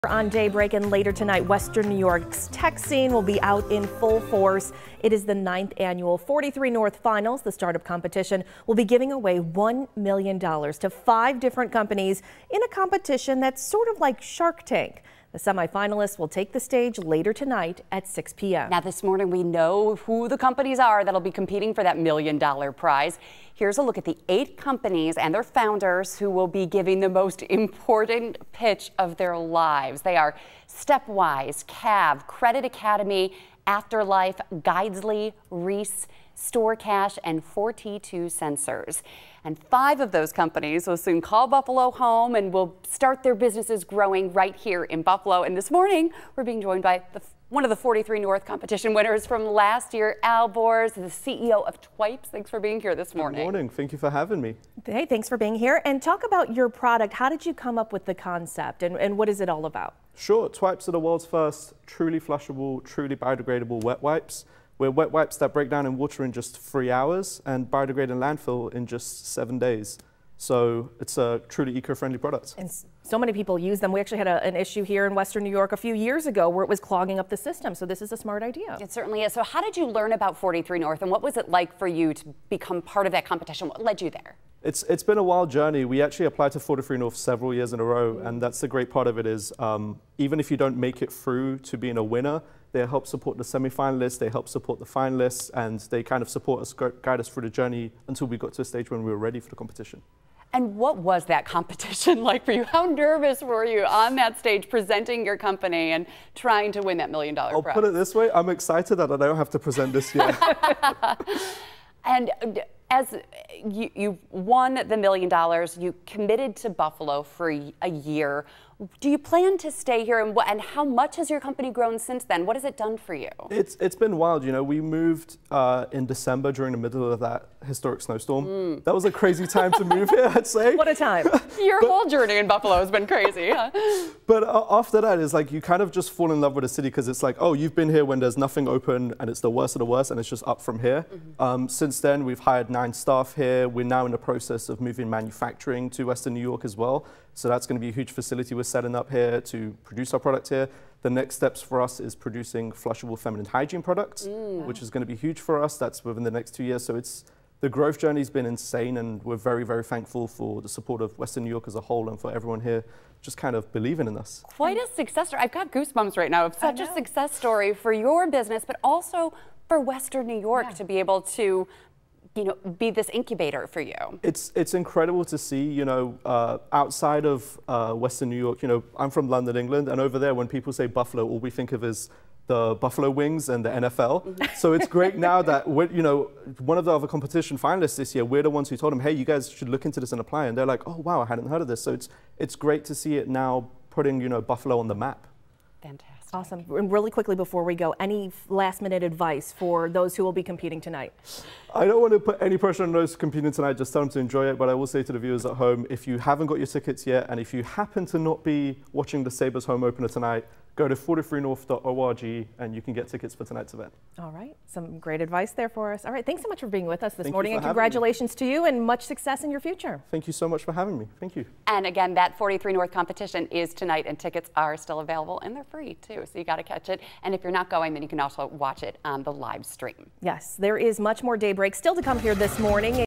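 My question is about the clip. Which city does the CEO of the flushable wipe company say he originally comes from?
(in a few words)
London.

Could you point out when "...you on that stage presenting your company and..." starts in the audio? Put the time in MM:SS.
01:43.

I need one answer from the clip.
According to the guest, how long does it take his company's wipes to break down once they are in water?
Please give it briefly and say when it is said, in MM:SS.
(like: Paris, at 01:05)
3 hours, at 01:06.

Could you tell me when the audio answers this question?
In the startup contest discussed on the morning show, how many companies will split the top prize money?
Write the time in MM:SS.
00:10.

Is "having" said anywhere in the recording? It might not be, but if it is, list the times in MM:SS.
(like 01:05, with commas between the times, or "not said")
00:54, 03:40.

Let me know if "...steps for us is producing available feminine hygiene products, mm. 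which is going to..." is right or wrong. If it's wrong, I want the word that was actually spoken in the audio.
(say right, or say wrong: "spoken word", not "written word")
wrong: "flushable", not "available".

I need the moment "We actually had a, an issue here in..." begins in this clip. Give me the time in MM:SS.
01:13.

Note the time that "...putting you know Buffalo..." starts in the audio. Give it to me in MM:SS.
03:13.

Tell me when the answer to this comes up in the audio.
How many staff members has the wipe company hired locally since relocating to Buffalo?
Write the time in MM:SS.
02:22.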